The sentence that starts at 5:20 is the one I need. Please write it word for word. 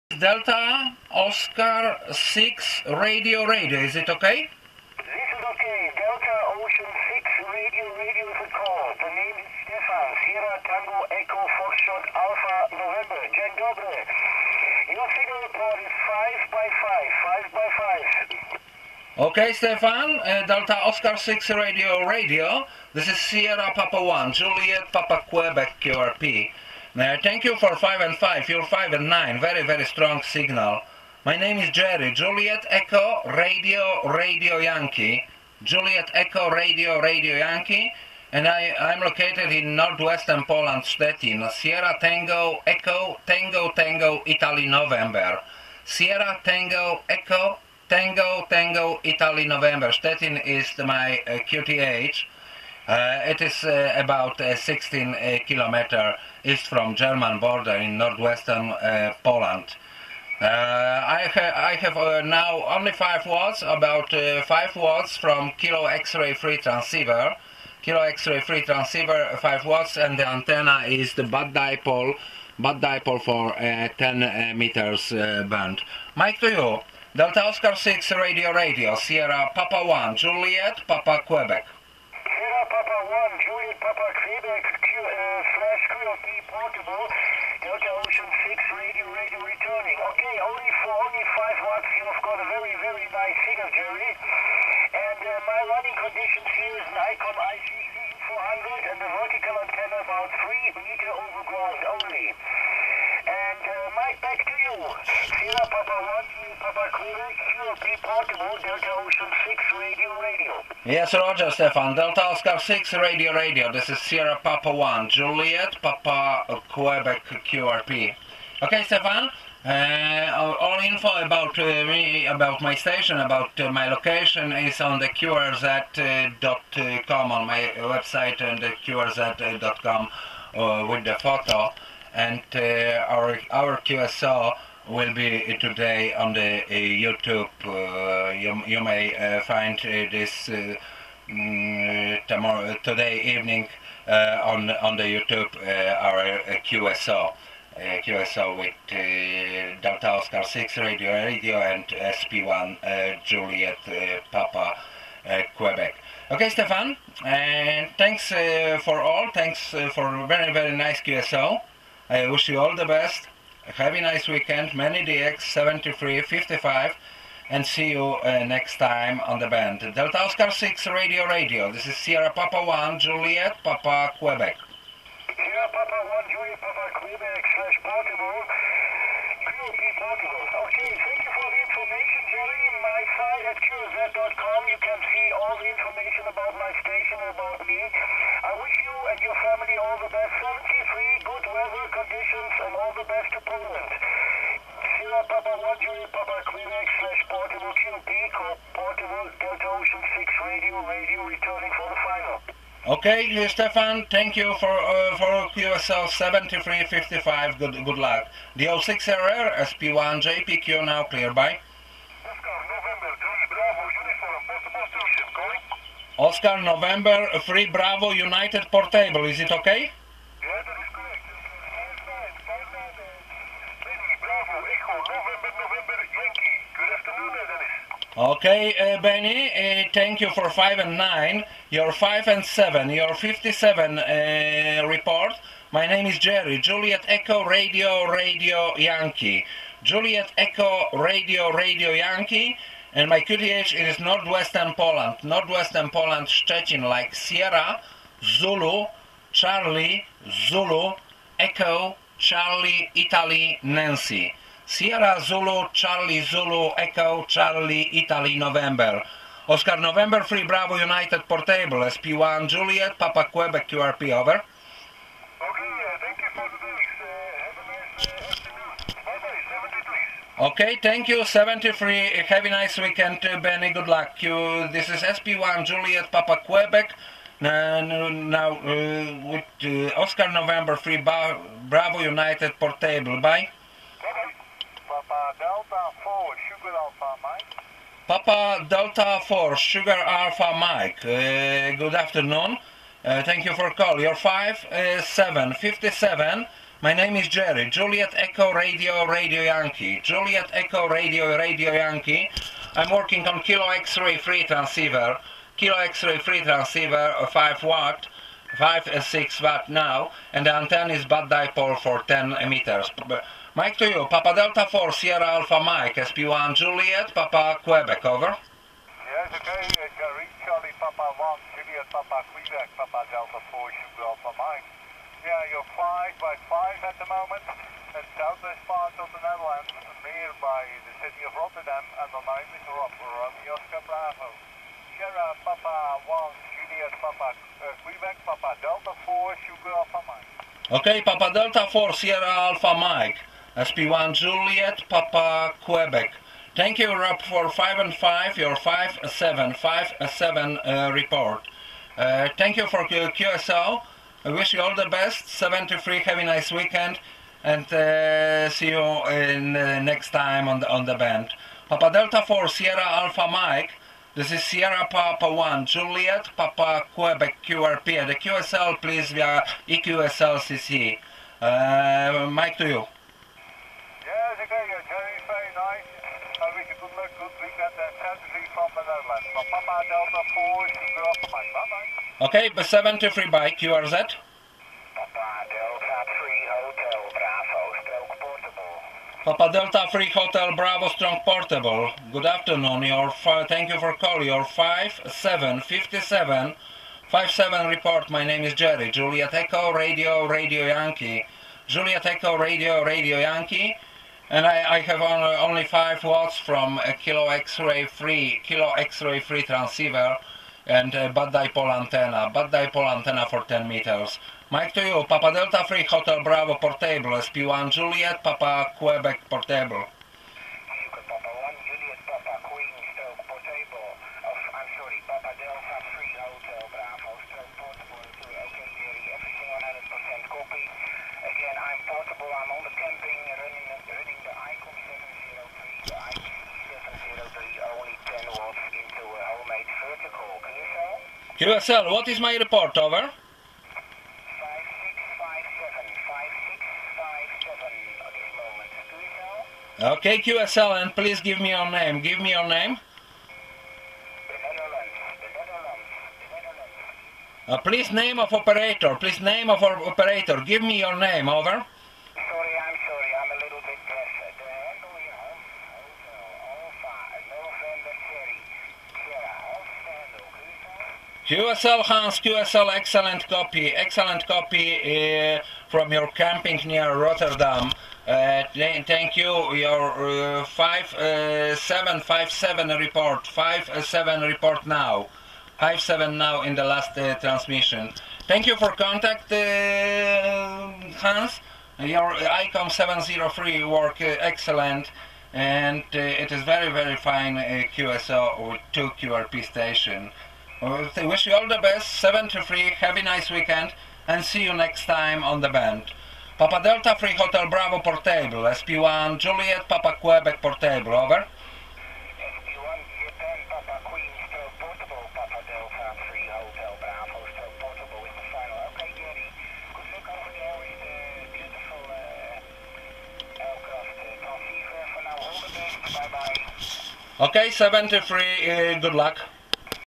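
Reach Charlie Papa 1, Juliet, Papa Quebec, Papa Delta 4, Sugar Alpha Mike.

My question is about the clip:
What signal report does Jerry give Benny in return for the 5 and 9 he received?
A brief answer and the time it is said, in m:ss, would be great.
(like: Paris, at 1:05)
57, at 3:51.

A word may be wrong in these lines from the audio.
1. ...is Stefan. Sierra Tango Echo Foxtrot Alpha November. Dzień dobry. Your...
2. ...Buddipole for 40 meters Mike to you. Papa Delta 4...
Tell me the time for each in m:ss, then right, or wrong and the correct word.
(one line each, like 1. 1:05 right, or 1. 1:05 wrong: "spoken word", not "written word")
1. 0:09 right
2. 5:11 wrong: "10", not "40".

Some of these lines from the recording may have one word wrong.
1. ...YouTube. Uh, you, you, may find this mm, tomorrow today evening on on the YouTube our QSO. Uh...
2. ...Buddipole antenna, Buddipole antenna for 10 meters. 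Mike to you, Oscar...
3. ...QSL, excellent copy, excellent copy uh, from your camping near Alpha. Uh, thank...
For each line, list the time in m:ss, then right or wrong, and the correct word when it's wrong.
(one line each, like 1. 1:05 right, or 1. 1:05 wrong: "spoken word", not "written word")
1. 2:16 right
2. 6:51 wrong: "Papa", not "Oscar"
3. 7:52 wrong: "Rotterdam", not "Alpha".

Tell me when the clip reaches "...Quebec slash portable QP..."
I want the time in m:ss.
3:16.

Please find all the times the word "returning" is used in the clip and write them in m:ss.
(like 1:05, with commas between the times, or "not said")
1:29, 3:21.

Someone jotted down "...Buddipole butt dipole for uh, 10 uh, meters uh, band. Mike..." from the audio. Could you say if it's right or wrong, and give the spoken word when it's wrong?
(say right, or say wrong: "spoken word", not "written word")
right.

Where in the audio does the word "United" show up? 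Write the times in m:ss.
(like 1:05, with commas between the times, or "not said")
3:38, 4:20, 4:41.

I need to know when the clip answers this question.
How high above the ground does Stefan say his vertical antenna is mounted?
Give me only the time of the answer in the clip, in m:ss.
1:40.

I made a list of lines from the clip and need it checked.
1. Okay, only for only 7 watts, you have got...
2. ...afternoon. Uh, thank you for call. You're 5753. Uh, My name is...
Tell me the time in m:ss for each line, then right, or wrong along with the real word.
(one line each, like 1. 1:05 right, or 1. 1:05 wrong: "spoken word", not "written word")
1. 1:30 wrong: "5", not "7"
2. 4:51 wrong: "5757", not "5753".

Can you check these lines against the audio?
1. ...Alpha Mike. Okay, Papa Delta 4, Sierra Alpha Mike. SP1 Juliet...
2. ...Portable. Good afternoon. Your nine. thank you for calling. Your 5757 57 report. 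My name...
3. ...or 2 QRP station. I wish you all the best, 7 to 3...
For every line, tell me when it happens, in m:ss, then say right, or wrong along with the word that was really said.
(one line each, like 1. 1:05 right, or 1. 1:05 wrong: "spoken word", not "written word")
1. 5:39 right
2. 6:31 wrong: "five", not "nine"
3. 8:18 right.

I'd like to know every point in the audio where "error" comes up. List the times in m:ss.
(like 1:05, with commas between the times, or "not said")
3:29.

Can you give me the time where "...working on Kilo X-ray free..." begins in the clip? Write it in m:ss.
5:02.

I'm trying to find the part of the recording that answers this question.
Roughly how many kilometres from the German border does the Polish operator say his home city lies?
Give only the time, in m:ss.
0:54.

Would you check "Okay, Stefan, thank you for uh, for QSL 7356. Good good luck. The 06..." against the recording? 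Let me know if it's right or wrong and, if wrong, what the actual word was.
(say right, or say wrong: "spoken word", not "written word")
wrong: "7355", not "7356".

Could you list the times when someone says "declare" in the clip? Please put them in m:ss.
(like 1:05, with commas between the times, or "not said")
not said.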